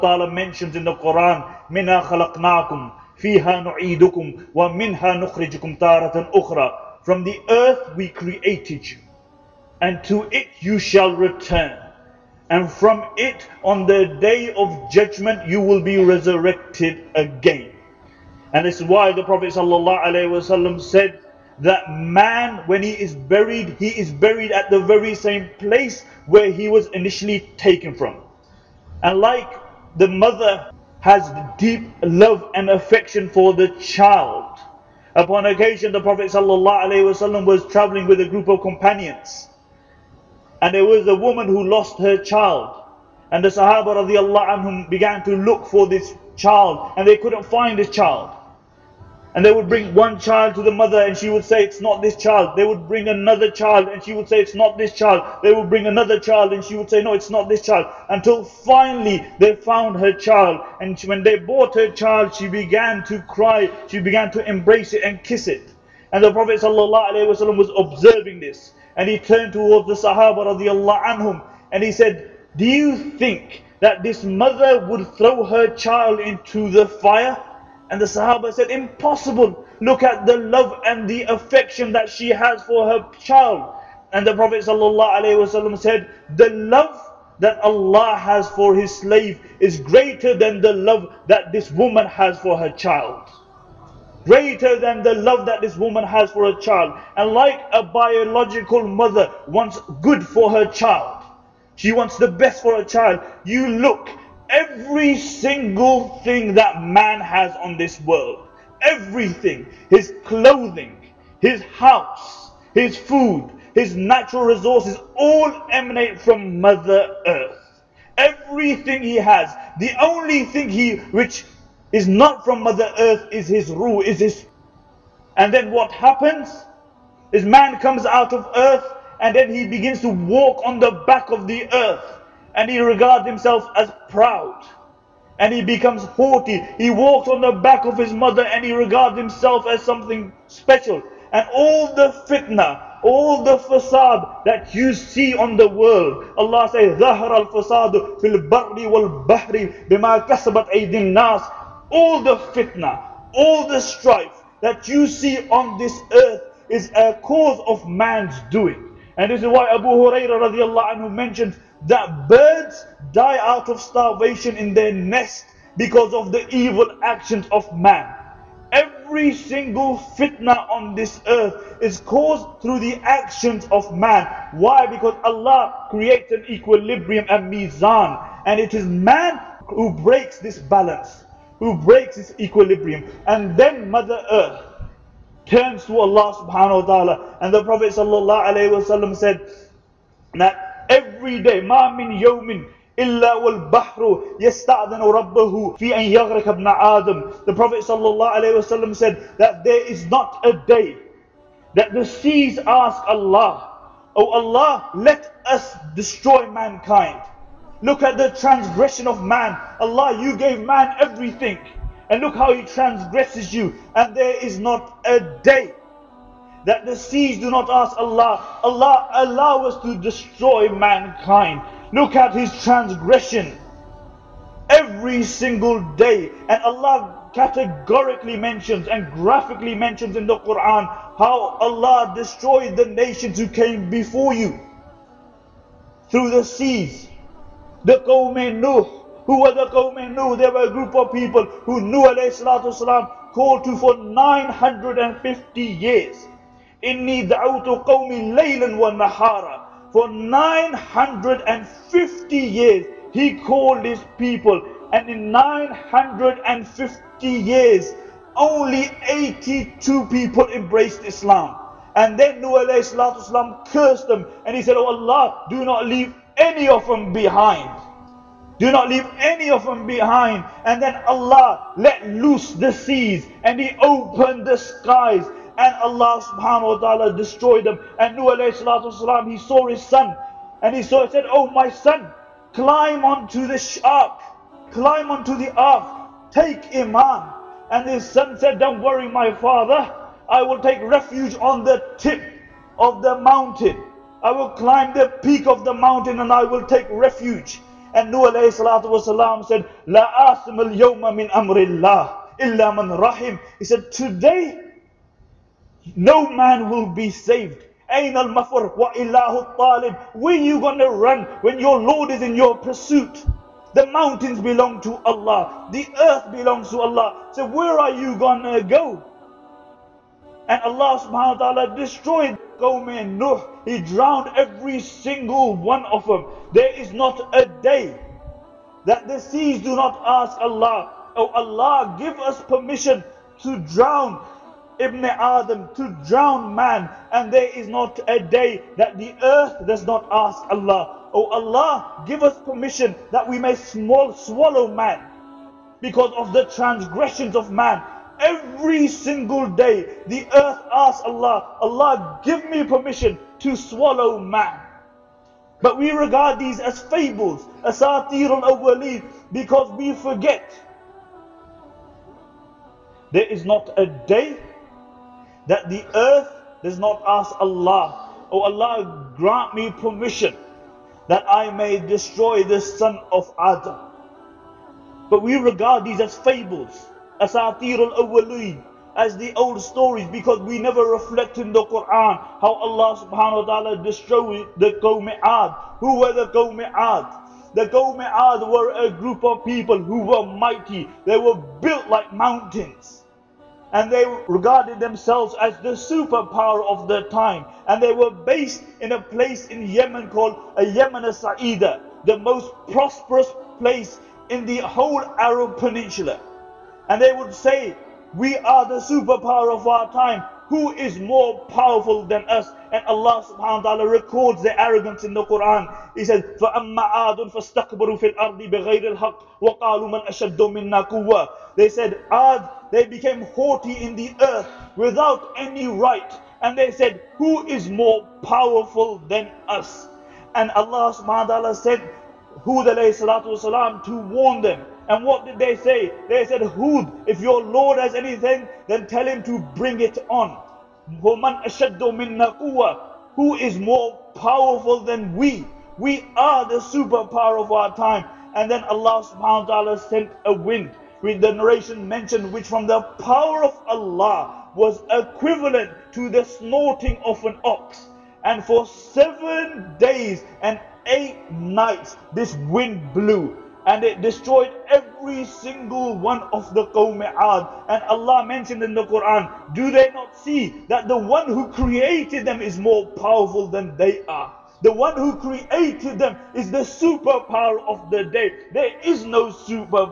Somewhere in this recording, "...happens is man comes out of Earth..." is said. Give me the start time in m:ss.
2:05.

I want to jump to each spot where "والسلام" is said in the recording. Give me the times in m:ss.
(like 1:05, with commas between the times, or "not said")
4:02, 4:22.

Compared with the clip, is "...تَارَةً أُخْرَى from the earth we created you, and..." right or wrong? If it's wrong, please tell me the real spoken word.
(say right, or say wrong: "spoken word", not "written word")
right.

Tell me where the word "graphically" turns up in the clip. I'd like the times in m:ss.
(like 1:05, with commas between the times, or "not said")
3:49.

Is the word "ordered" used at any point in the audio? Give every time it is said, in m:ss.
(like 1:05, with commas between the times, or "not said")
not said.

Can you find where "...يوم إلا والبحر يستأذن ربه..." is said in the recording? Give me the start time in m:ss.
3:12.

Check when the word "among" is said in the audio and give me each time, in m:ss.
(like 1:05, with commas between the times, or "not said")
not said.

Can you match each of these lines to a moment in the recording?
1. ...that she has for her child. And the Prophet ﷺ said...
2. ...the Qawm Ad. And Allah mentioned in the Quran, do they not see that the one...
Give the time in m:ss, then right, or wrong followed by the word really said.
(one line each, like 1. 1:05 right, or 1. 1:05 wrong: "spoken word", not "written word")
1. 1:21 right
2. 7:46 right.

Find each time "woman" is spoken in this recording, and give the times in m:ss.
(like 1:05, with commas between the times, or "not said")
0:41, 1:31, 1:35.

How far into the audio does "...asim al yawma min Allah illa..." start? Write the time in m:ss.
5:00.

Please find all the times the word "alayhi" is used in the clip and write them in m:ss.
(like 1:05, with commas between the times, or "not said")
4:38, 4:58, 7:12.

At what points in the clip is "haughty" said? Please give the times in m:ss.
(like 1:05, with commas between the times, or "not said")
2:16, 7:03.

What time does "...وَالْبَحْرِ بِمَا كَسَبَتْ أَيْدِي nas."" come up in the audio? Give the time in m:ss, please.
2:29.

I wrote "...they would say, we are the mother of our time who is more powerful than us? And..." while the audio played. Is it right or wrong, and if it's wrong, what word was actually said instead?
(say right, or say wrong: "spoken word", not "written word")
wrong: "superpower", not "mother".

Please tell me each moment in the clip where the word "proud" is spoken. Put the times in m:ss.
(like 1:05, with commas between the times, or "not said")
2:14.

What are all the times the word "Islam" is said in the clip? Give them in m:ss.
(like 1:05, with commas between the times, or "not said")
4:21.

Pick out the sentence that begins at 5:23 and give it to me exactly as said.
He drowned every single one of them.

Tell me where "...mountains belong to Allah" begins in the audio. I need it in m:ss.
5:13.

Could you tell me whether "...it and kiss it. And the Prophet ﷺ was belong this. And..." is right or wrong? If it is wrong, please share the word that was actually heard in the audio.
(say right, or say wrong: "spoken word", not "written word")
wrong: "observing", not "belong".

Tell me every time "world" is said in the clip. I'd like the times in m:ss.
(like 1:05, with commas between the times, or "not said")
1:48, 2:25.